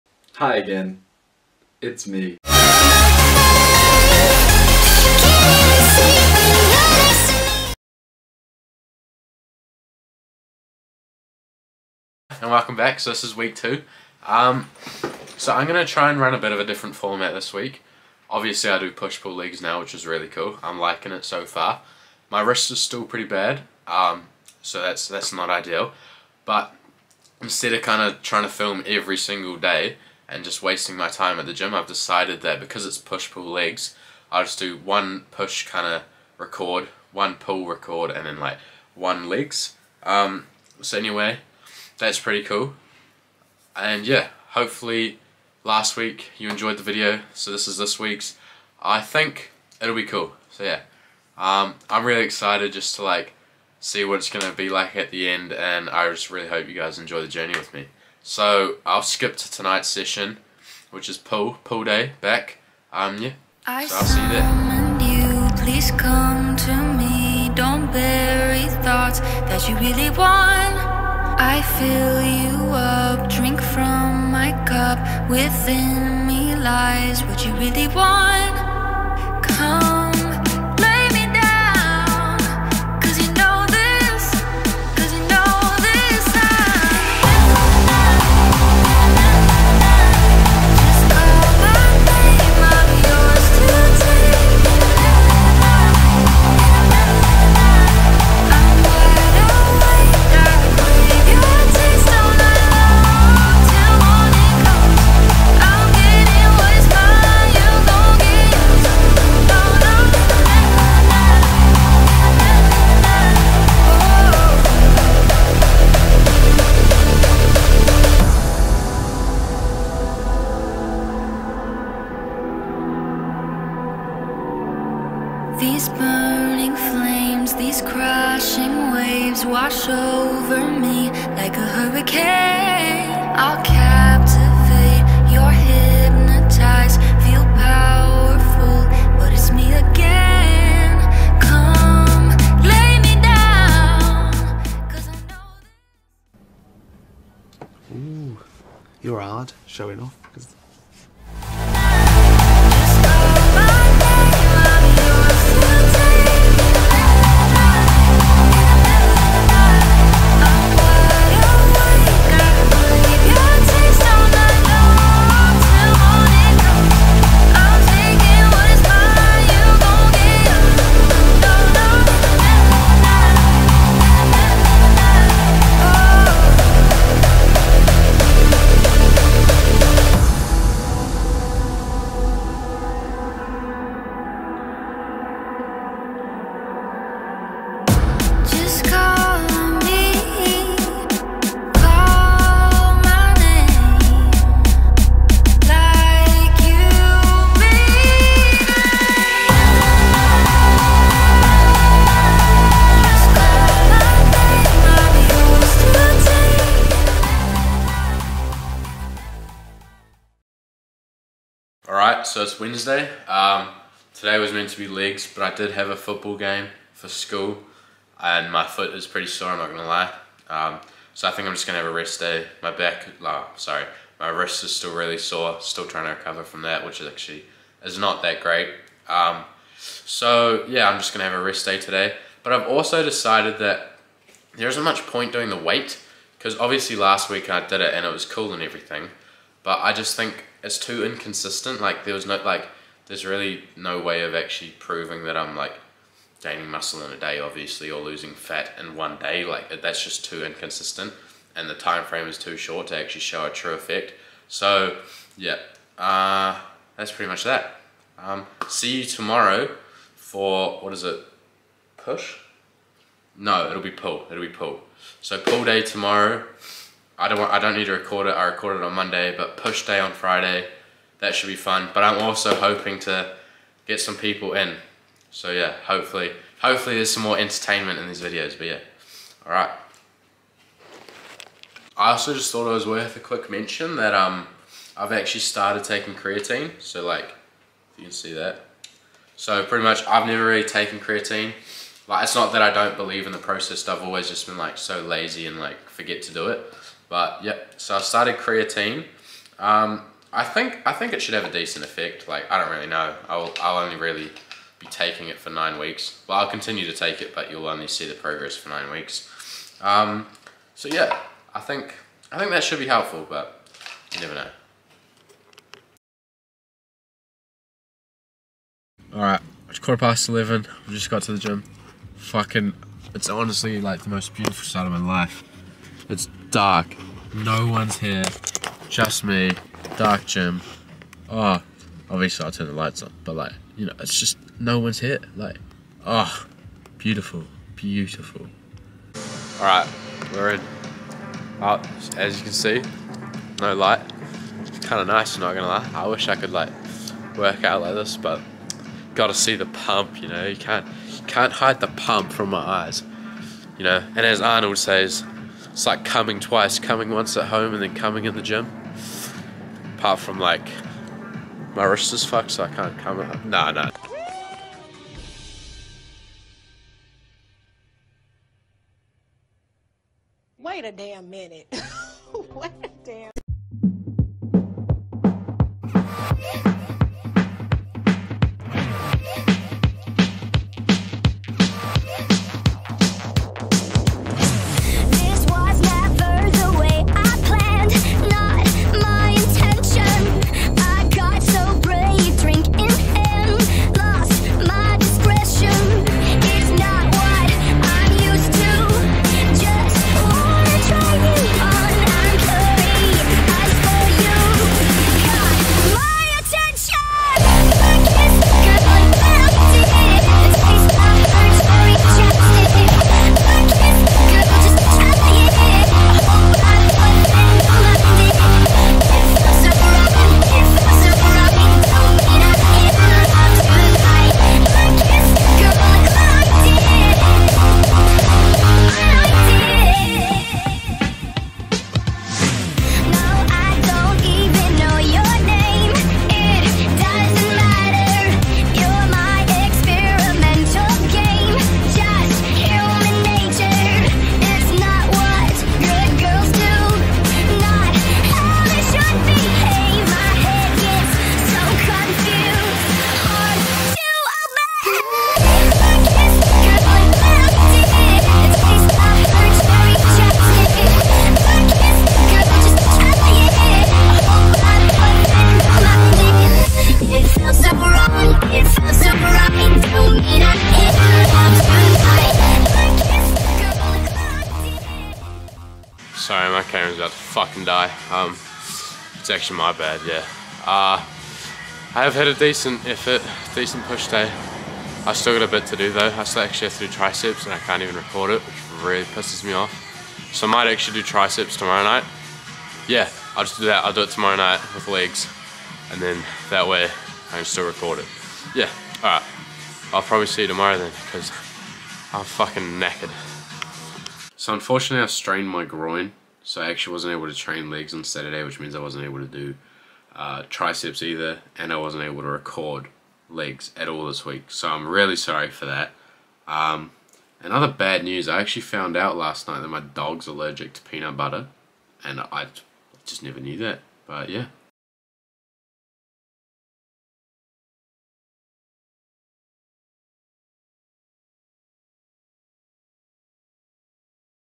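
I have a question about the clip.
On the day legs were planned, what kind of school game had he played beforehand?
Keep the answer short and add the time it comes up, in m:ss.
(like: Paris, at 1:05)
Football, at 3:35.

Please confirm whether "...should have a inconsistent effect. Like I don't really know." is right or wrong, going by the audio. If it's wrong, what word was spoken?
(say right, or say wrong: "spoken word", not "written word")
wrong: "decent", not "inconsistent".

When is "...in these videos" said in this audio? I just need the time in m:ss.
4:37.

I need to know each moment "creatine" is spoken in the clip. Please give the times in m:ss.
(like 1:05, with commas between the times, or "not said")
4:46, 4:50, 4:58.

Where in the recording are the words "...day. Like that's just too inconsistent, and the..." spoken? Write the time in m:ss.
4:09.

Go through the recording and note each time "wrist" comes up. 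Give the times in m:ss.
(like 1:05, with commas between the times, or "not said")
0:22, 3:44, 6:01.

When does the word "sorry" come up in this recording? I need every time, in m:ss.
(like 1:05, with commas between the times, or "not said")
3:43, 7:56, 8:35.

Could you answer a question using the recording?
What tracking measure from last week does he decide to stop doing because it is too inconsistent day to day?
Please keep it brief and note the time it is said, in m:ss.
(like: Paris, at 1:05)
The weight, at 3:55.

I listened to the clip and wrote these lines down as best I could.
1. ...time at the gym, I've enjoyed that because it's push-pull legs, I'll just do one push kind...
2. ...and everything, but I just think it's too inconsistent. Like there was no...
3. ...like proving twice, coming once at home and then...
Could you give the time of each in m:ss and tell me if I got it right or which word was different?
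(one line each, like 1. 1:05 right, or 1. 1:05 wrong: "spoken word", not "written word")
1. 0:31 wrong: "decided", not "enjoyed"
2. 3:58 right
3. 5:55 wrong: "coming", not "proving".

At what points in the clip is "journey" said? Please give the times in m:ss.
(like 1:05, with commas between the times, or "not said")
0:57.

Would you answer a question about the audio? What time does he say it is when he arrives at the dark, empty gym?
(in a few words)
Quarter past eleven.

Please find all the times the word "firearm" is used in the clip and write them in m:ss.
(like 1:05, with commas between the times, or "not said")
not said.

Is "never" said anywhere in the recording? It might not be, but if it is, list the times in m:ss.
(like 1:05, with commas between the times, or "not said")
4:50, 5:14, 8:43.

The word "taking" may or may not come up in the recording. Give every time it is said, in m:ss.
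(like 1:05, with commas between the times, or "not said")
4:45, 5:04.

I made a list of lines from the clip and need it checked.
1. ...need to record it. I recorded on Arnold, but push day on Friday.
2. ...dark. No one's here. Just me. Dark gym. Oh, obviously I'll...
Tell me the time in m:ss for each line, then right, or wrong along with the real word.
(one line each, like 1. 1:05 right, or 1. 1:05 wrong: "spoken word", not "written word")
1. 4:27 wrong: "Monday", not "Arnold"
2. 5:26 right.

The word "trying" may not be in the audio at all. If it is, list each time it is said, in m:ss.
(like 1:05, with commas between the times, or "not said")
0:28, 3:45.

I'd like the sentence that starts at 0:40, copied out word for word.
Um, so anyway, that's pretty cool.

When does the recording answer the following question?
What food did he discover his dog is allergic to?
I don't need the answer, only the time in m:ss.
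8:40.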